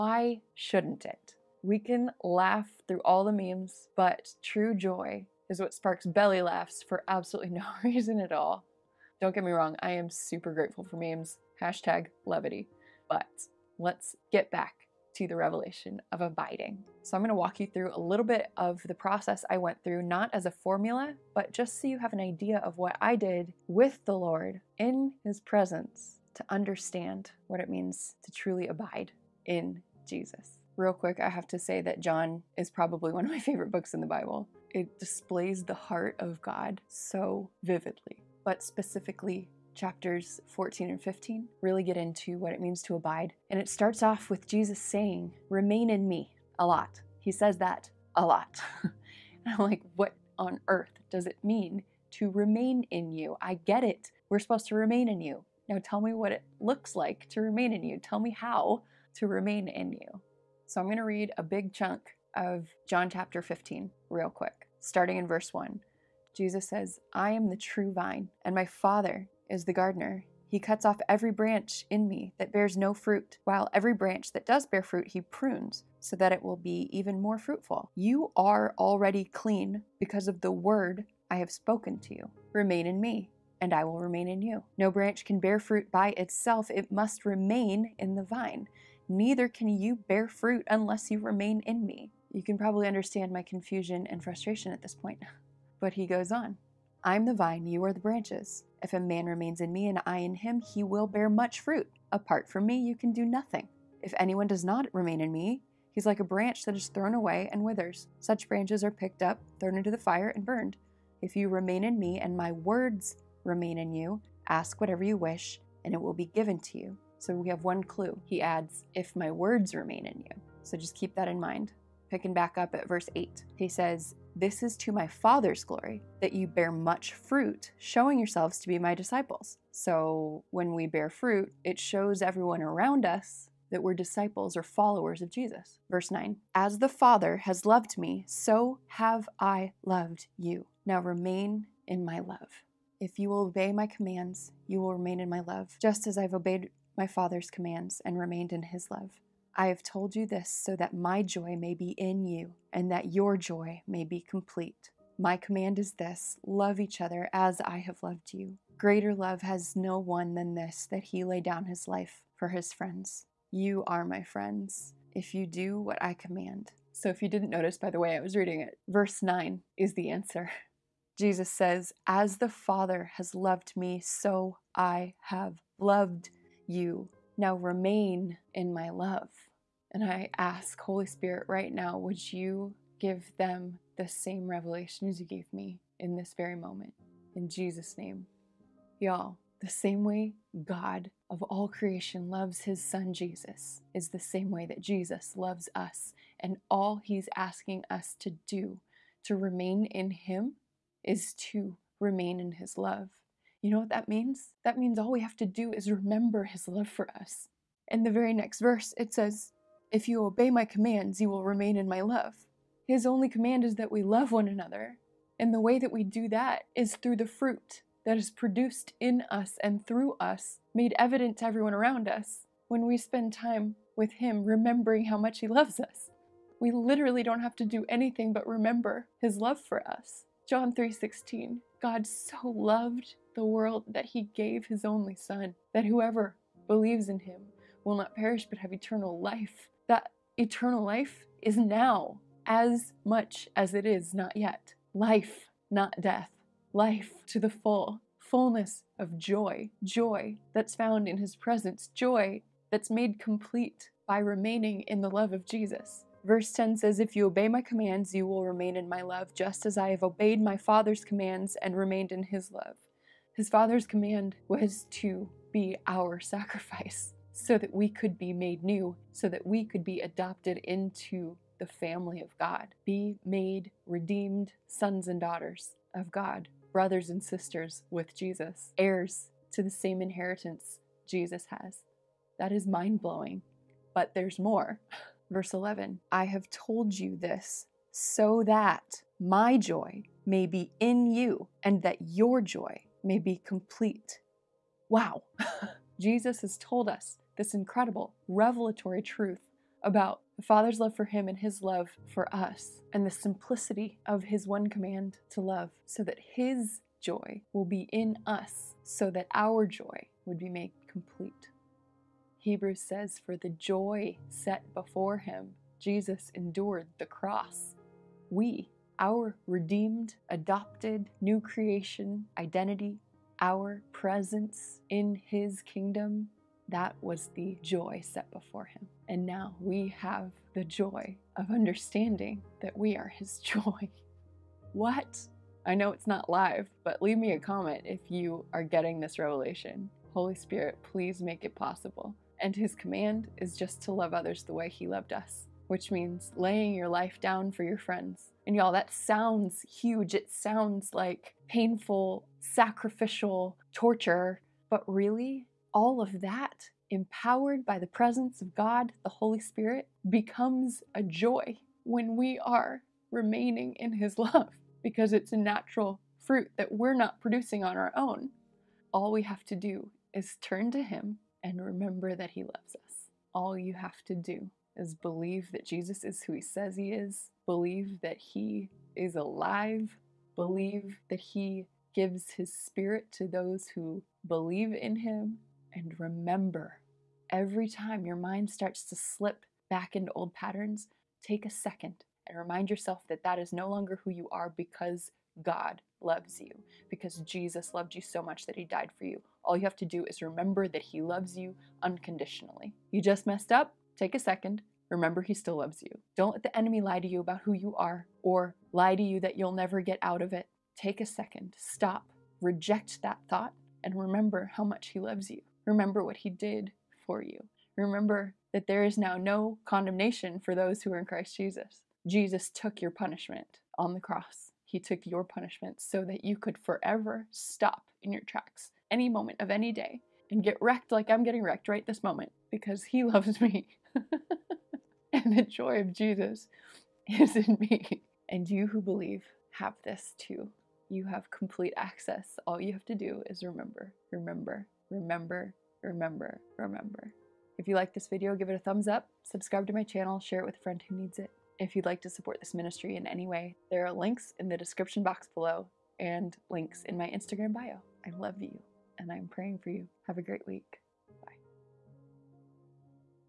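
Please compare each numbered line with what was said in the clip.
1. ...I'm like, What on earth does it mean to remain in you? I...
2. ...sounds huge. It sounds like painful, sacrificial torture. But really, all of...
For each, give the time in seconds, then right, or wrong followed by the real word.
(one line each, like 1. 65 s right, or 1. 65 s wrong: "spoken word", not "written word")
1. 49 s right
2. 348 s right.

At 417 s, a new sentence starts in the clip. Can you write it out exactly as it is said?
Remember that there is now no condemnation for those who are in Christ Jesus.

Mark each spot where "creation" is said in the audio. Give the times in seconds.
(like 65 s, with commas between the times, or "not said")
191 s, 321 s.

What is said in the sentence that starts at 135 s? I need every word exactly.
Verse 9 As the Father has loved me, so have I loved you.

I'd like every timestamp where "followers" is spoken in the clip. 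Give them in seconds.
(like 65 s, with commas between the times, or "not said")
134 s.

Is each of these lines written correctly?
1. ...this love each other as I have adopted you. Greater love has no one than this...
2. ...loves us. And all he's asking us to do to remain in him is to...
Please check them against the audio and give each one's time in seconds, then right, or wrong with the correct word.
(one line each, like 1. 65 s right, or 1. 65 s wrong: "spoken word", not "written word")
1. 155 s wrong: "loved", not "adopted"
2. 195 s right.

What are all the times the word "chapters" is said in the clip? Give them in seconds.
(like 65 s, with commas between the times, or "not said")
39 s, 63 s.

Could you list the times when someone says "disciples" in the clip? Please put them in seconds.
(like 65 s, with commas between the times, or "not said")
128 s, 133 s.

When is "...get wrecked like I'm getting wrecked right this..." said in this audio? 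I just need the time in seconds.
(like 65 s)
430 s.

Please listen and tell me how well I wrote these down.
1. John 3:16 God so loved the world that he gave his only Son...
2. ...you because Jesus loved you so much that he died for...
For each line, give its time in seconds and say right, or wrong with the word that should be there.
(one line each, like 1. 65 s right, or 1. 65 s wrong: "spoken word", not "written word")
1. 230 s right
2. 396 s right.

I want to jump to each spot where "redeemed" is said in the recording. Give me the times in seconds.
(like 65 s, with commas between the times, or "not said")
273 s, 319 s.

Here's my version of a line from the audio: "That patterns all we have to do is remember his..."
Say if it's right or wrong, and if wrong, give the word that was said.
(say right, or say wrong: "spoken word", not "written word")
wrong: "means", not "patterns".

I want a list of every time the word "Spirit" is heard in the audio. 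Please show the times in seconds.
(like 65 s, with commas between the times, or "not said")
181 s, 340 s, 359 s, 382 s.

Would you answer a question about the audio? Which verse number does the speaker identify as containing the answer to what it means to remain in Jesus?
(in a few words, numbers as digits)
verse 9.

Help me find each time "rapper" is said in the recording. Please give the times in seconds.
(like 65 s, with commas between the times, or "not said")
not said.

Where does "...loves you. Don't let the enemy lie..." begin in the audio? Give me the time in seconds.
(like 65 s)
405 s.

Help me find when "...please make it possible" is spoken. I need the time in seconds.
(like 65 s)
340 s.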